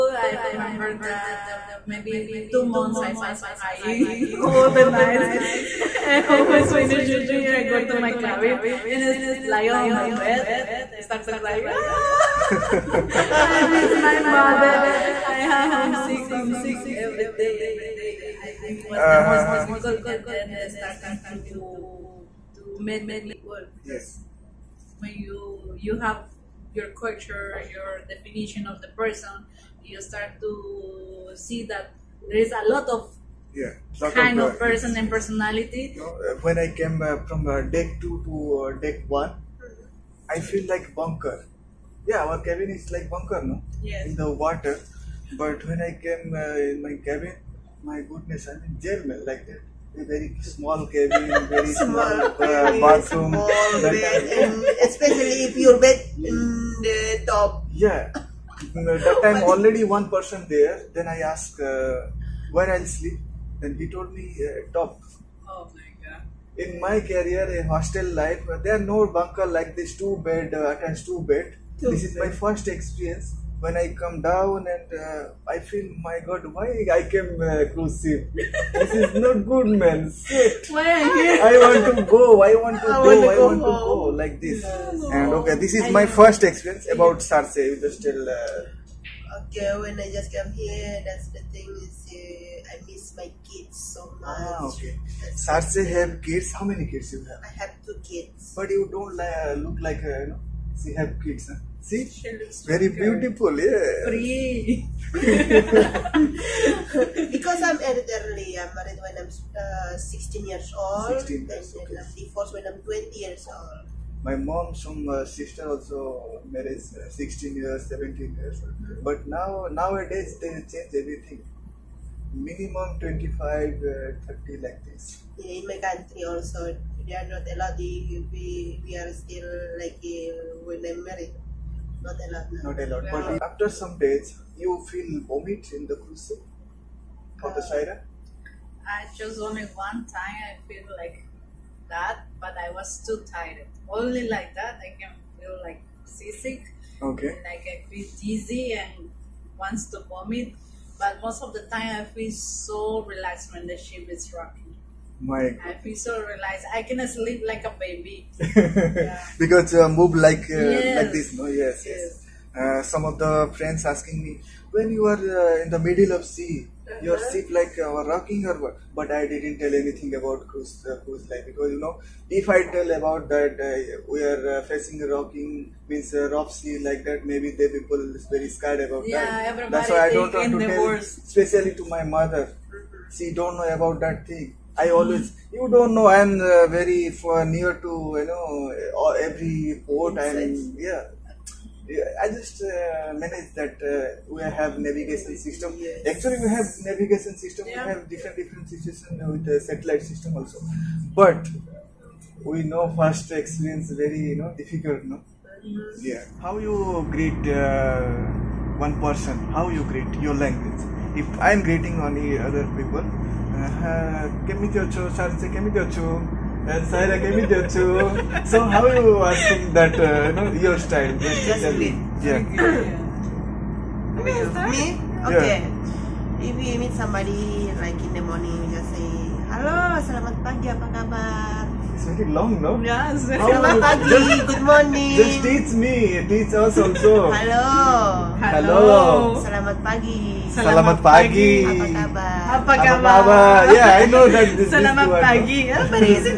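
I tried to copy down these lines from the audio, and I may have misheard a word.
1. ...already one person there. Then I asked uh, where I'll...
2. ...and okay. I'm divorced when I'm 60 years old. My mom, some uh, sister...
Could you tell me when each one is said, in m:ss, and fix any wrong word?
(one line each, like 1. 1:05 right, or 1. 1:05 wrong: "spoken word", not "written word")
1. 0:59 right
2. 1:51 wrong: "20", not "60".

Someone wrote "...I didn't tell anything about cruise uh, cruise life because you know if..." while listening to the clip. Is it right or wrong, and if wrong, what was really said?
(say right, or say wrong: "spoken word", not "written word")
right.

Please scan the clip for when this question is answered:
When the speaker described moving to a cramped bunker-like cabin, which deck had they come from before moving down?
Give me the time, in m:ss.
0:37.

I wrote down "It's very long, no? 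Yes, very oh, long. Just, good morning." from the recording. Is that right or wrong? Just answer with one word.
right.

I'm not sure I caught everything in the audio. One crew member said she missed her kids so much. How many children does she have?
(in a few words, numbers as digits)
2.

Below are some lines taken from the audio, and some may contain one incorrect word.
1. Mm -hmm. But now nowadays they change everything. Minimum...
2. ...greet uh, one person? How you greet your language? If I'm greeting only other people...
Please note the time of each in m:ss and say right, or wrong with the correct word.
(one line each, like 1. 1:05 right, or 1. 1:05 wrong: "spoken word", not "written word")
1. 1:58 right
2. 3:27 right.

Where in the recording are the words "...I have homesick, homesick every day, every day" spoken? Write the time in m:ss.
0:15.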